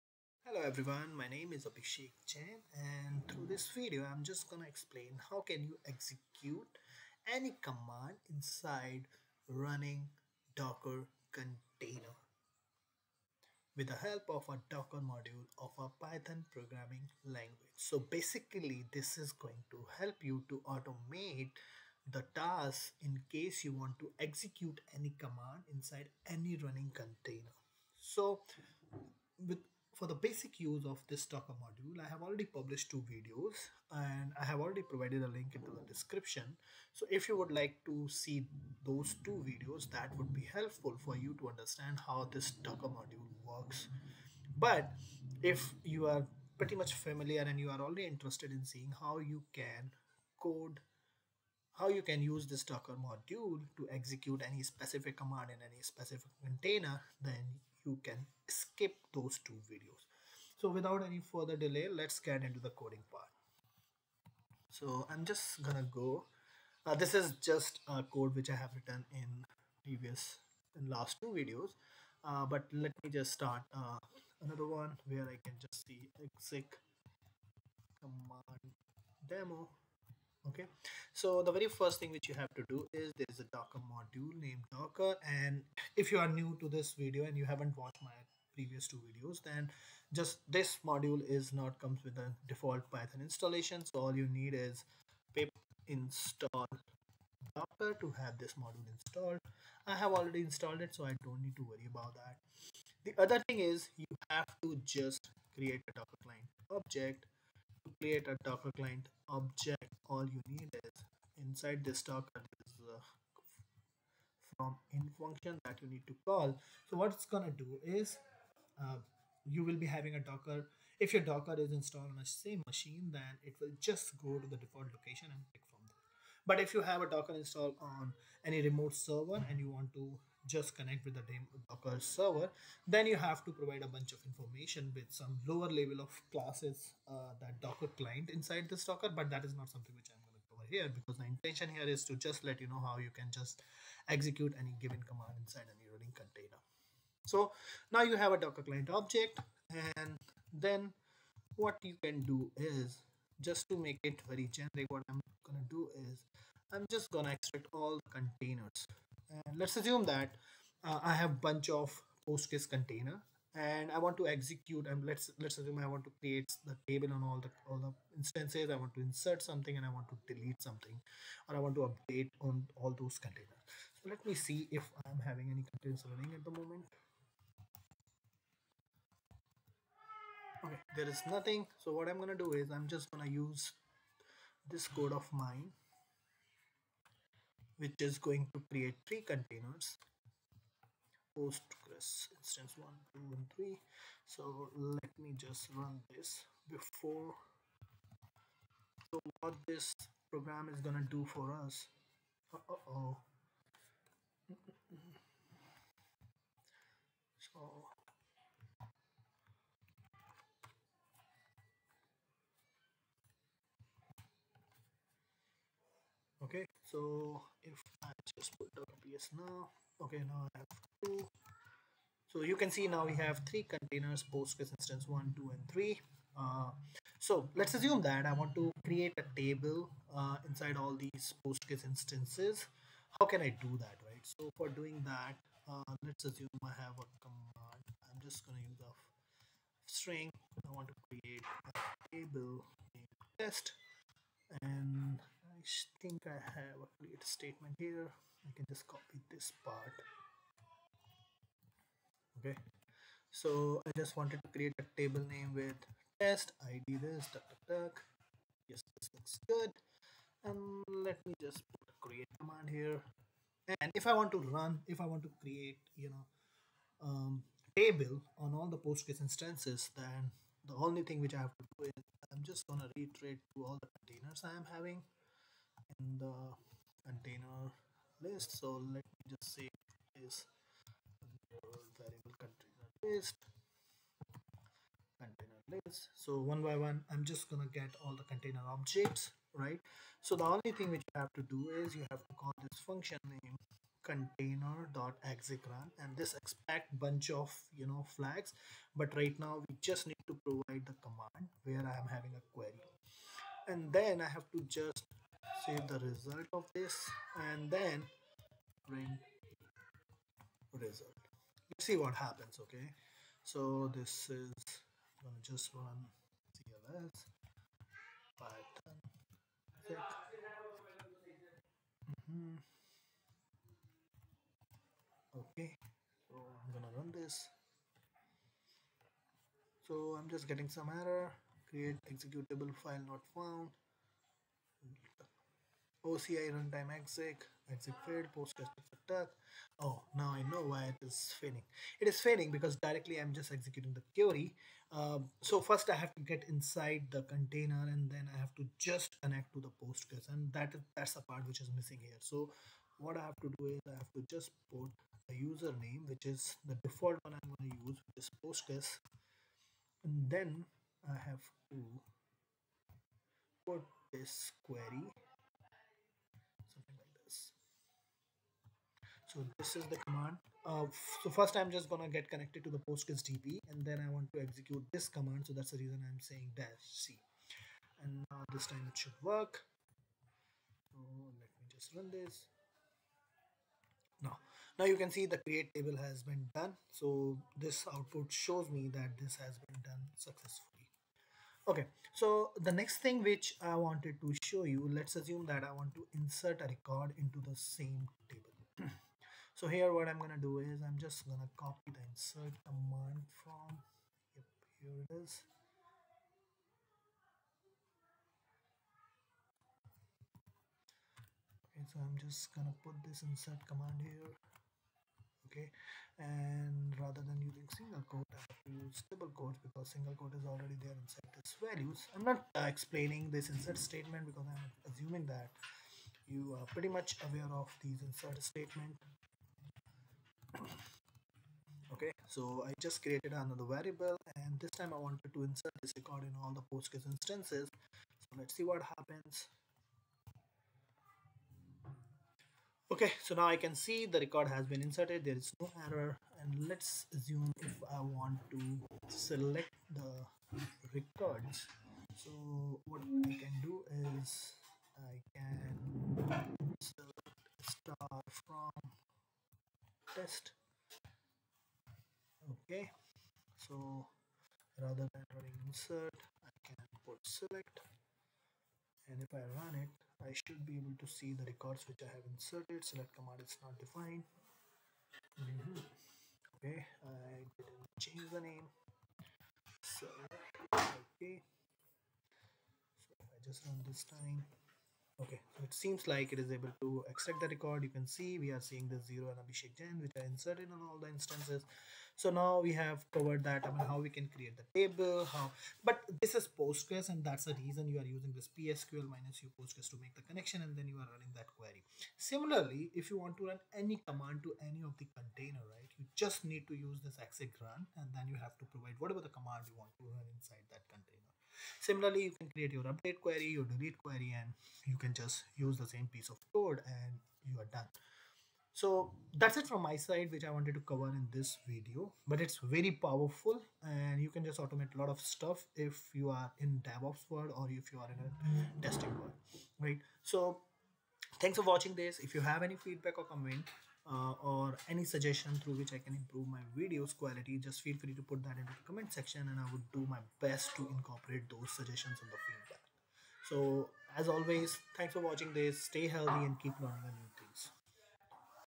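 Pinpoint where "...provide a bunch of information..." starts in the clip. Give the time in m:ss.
2:13.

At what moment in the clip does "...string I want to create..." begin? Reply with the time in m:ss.
3:59.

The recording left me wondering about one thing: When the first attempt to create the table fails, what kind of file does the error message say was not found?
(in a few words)
executable file.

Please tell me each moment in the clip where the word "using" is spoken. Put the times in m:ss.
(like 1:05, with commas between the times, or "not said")
6:57, 8:18.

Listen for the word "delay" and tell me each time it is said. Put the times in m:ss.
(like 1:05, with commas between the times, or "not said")
1:01.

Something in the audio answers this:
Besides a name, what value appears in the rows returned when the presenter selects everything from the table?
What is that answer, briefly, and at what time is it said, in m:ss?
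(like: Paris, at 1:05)
0, at 8:09.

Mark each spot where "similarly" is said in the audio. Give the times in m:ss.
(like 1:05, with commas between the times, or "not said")
8:22, 8:31.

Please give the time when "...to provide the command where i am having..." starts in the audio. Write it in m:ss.
5:00.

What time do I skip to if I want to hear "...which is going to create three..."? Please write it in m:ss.
3:07.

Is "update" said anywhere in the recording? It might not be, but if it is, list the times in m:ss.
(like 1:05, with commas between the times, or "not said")
2:51, 8:32.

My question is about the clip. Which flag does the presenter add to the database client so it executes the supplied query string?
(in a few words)
-c.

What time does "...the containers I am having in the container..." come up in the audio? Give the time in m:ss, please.
4:33.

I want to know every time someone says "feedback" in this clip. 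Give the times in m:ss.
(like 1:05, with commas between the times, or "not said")
8:52, 9:02.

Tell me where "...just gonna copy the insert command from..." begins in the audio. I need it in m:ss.
6:40.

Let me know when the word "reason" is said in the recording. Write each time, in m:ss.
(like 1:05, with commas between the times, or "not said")
6:15, 8:17.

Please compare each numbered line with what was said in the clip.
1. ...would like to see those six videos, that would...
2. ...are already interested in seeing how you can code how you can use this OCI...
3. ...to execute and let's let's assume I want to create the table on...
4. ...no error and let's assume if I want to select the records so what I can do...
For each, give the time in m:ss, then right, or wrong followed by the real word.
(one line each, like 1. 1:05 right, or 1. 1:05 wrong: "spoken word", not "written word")
1. 0:37 wrong: "two", not "six"
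2. 0:47 wrong: "Docker", not "OCI"
3. 2:44 right
4. 7:25 right.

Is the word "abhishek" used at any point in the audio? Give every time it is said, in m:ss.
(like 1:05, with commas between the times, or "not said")
0:01, 8:09.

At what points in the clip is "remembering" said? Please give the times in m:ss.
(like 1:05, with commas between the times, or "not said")
not said.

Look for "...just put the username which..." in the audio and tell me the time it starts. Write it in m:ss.
5:54.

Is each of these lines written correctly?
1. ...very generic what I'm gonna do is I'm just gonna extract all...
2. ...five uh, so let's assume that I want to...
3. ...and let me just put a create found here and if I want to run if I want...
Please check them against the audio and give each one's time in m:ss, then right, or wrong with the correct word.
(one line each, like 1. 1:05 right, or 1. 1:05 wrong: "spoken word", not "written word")
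1. 2:34 right
2. 3:45 wrong: "three", not "five"
3. 4:20 wrong: "command", not "found".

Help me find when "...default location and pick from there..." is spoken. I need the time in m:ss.
2:04.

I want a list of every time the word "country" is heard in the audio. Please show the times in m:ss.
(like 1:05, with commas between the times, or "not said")
not said.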